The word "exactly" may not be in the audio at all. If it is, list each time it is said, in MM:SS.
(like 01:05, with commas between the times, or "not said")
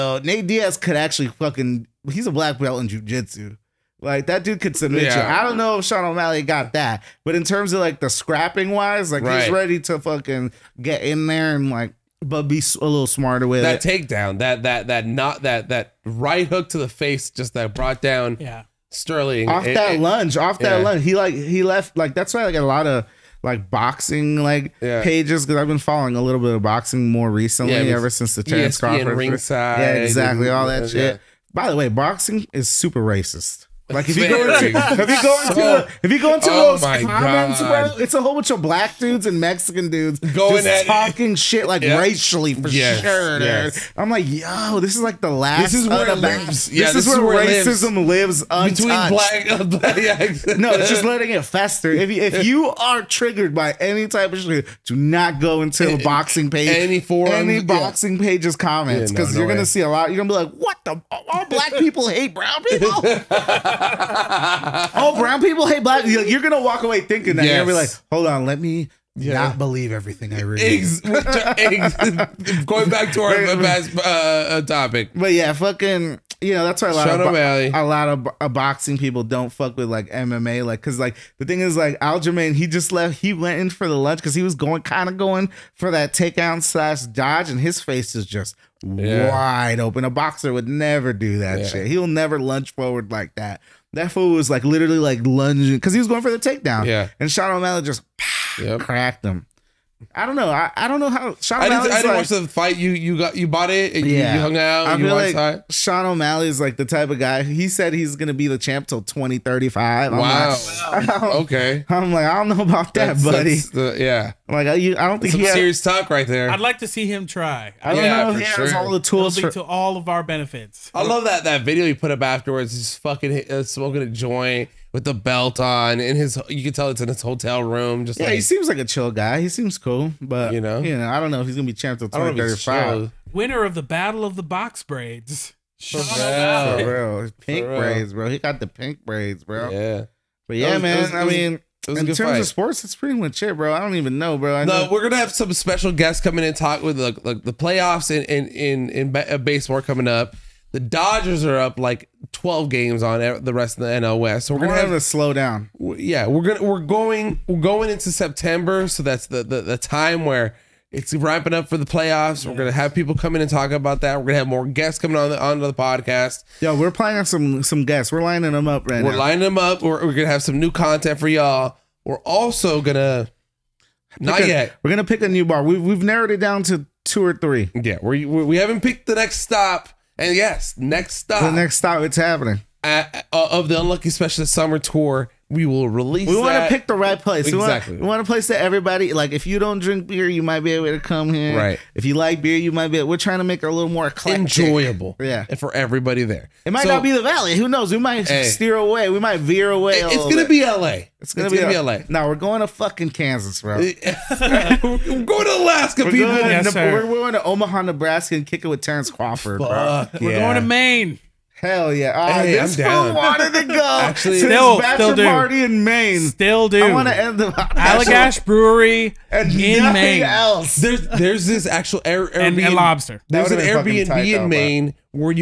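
00:29, 03:07.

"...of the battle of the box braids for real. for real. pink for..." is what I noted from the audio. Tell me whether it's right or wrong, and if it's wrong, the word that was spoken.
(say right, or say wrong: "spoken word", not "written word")
right.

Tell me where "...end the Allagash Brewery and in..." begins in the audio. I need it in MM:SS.
03:37.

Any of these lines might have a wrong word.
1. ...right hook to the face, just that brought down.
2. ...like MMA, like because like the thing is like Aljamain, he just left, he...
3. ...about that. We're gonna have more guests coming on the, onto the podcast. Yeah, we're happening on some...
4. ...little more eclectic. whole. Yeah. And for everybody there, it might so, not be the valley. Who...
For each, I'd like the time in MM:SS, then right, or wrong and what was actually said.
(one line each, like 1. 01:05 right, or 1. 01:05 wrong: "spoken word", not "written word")
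1. 00:16 right
2. 01:19 right
3. 02:43 wrong: "planning", not "happening"
4. 03:13 wrong: "enjoyable", not "whole".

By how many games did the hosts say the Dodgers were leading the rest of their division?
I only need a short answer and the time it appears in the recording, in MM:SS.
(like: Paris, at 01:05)
12, at 02:32.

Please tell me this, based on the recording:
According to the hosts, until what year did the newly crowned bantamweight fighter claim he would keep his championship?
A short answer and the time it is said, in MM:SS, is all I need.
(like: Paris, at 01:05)
2035, at 01:49.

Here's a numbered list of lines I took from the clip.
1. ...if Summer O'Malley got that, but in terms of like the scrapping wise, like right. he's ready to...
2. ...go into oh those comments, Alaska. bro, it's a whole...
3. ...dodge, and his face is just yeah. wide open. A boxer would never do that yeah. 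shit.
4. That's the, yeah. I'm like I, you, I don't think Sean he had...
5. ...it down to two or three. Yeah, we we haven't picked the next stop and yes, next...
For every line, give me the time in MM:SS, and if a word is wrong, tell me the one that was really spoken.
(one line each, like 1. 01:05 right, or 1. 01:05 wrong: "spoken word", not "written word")
1. 00:05 wrong: "Sean", not "Summer"
2. 00:36 wrong: "God", not "Alaska"
3. 01:27 right
4. 01:53 wrong: "Some", not "Sean"
5. 02:56 right.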